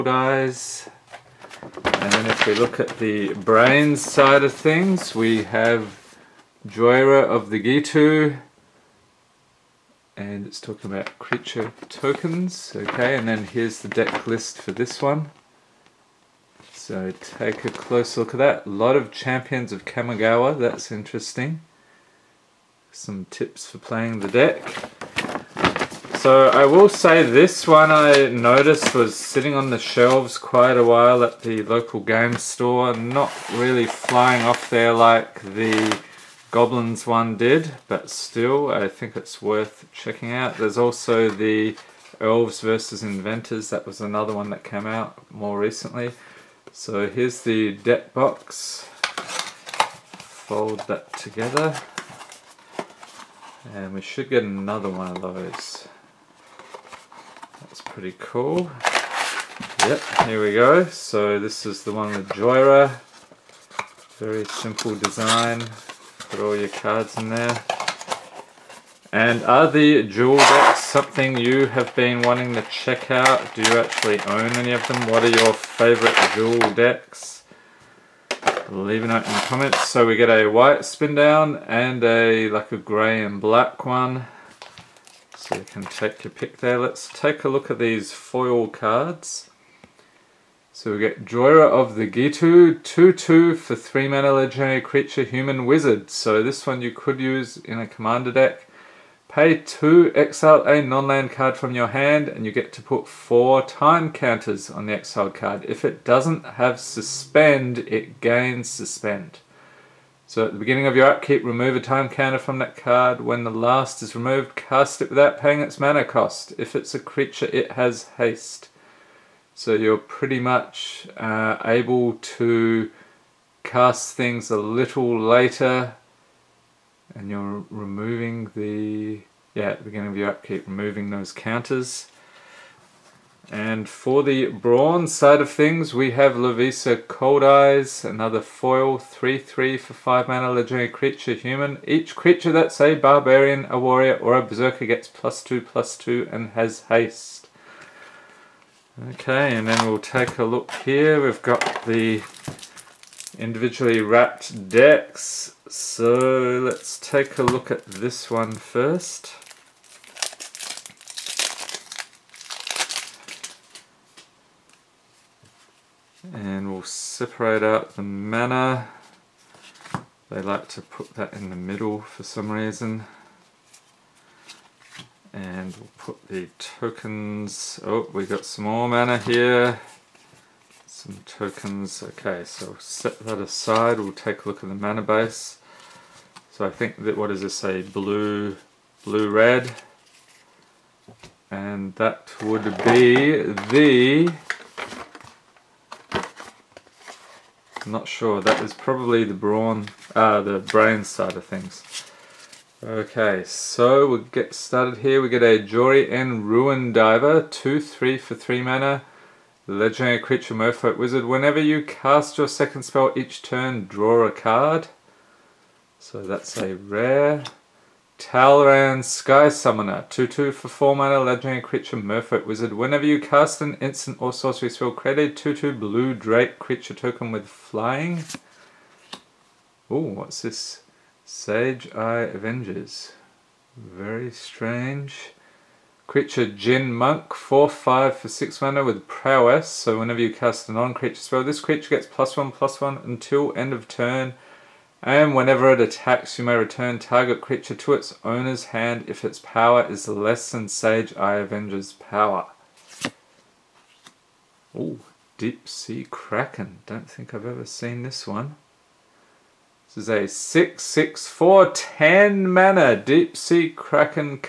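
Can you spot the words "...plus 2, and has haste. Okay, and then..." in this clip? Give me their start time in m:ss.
2:25.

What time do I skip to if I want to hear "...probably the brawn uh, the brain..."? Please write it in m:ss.
3:18.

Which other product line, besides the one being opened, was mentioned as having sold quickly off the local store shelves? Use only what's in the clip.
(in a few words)
Goblins.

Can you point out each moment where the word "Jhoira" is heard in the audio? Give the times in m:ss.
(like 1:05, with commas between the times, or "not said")
0:06, 1:02, 1:31.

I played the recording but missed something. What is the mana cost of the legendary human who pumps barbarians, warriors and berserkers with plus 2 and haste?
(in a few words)
5.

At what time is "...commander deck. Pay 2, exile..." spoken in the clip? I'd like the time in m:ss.
1:37.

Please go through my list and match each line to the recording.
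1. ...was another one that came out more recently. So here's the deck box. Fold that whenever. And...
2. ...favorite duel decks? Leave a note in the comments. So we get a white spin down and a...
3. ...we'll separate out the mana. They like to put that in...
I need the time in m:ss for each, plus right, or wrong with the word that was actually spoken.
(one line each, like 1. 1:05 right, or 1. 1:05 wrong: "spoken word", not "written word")
1. 0:43 wrong: "together", not "whenever"
2. 1:15 right
3. 2:46 right.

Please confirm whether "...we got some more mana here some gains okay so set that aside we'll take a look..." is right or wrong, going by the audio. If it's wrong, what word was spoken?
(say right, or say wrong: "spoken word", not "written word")
wrong: "tokens", not "gains".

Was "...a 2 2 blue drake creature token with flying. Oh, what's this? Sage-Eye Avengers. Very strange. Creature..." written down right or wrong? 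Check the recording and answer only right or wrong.
right.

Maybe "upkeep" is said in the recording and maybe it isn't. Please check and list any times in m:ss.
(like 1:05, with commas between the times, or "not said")
1:51, 2:10.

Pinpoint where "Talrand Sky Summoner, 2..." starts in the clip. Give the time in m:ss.
3:38.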